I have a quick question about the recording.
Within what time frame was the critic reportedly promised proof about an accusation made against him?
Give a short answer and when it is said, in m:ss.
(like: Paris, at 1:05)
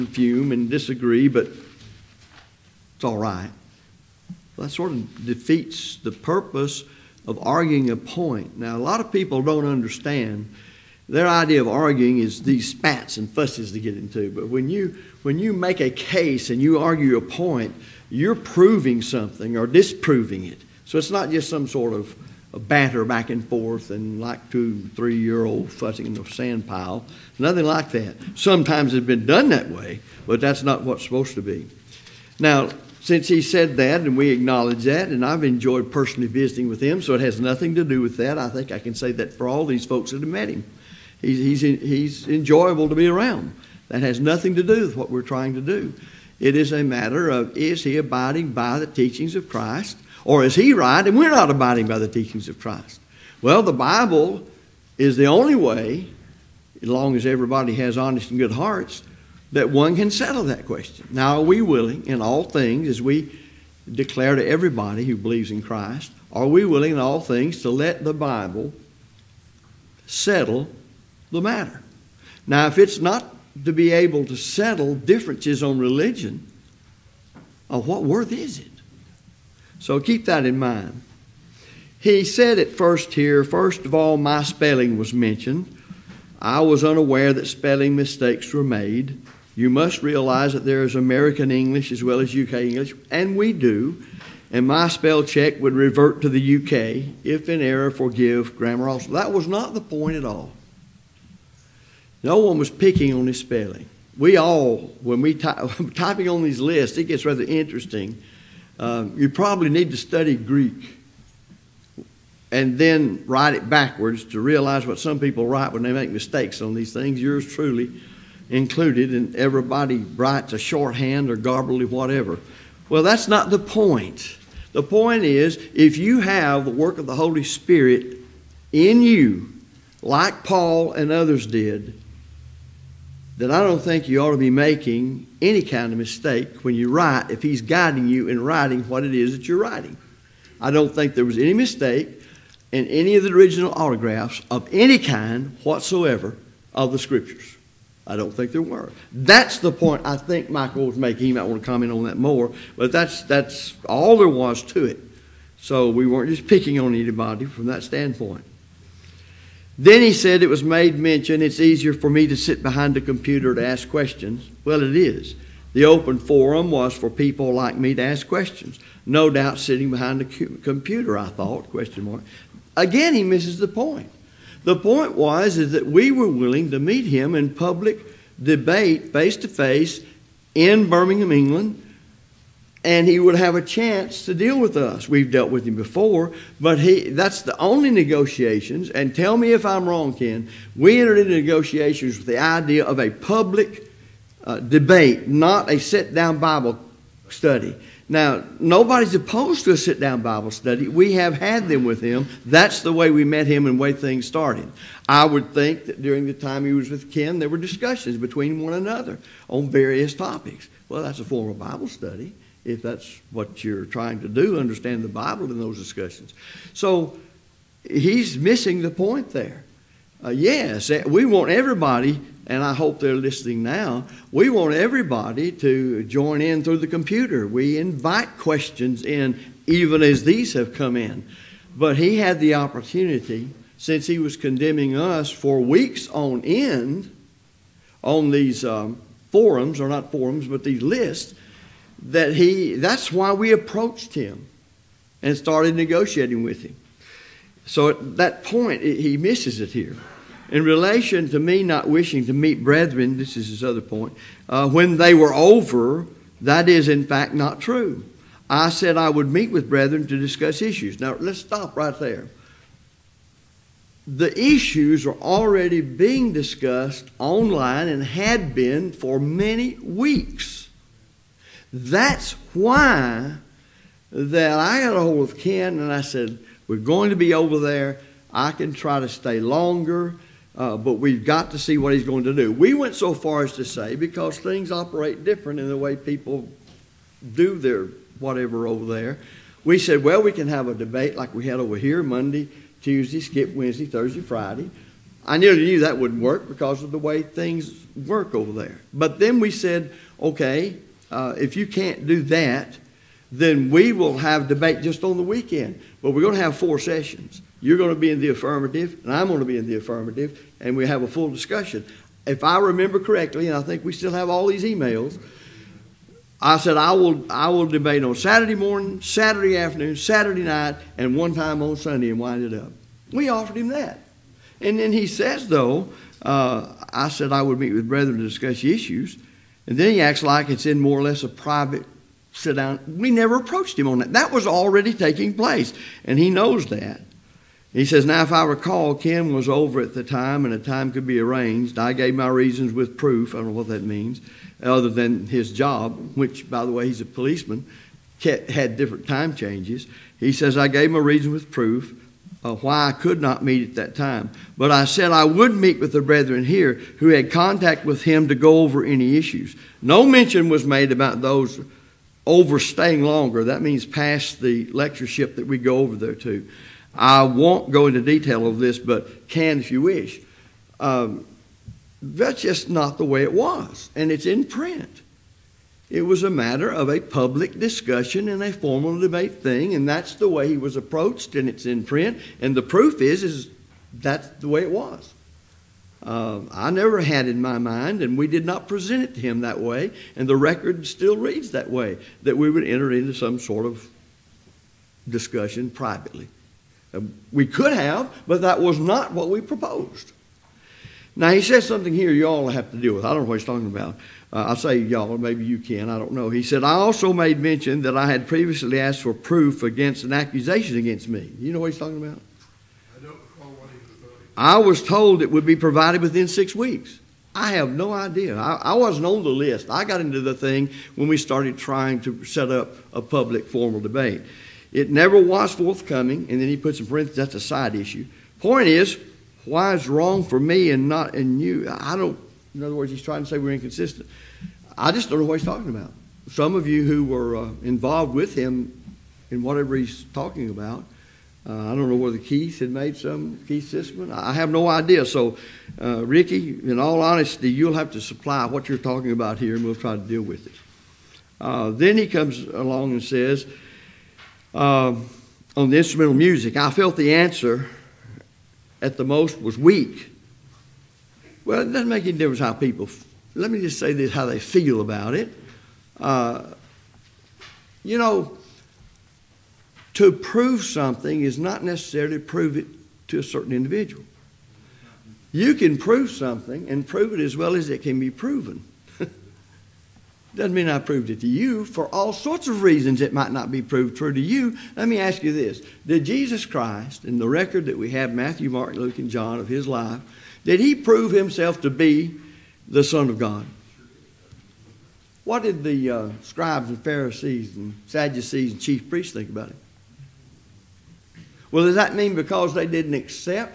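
6 weeks, at 6:56.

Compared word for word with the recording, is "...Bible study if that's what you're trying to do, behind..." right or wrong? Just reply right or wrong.
wrong.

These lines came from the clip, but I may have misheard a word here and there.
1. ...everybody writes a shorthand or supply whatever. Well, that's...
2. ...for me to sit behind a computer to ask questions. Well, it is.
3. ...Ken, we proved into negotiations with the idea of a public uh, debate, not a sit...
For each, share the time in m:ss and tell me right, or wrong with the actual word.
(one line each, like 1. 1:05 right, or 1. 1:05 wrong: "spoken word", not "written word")
1. 1:59 wrong: "garbly", not "supply"
2. 2:41 right
3. 3:10 wrong: "entered", not "proved".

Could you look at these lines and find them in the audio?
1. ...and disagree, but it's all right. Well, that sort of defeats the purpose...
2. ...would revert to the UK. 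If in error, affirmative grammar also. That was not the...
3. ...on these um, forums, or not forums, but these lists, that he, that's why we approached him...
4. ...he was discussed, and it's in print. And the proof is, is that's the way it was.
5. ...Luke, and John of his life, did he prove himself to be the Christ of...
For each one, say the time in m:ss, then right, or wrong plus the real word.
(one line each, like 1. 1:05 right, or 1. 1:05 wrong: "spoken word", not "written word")
1. 0:00 right
2. 1:35 wrong: "forgive", not "affirmative"
3. 3:58 right
4. 6:20 wrong: "approached", not "discussed"
5. 8:08 wrong: "Son", not "Christ".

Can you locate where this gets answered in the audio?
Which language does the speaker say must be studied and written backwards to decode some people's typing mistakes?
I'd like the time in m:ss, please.
1:50.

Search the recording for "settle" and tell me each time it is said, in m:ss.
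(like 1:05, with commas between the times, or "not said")
1:00, 1:10, 1:14.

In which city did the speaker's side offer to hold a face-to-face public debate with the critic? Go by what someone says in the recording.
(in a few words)
Birmingham.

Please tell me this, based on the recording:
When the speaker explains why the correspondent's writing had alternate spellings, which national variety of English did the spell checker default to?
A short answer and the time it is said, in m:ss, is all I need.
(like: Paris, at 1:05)
UK English, at 1:32.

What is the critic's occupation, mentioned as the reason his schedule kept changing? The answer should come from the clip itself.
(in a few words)
Policeman.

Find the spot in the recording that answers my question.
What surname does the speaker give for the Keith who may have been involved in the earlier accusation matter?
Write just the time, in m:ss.
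7:23.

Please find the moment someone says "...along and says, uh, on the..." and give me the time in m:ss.
7:32.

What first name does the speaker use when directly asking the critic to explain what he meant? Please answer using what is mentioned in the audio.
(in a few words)
Ricky.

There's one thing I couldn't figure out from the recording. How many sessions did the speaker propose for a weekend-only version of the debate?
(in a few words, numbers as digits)
4.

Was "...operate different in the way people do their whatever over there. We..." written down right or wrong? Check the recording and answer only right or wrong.
right.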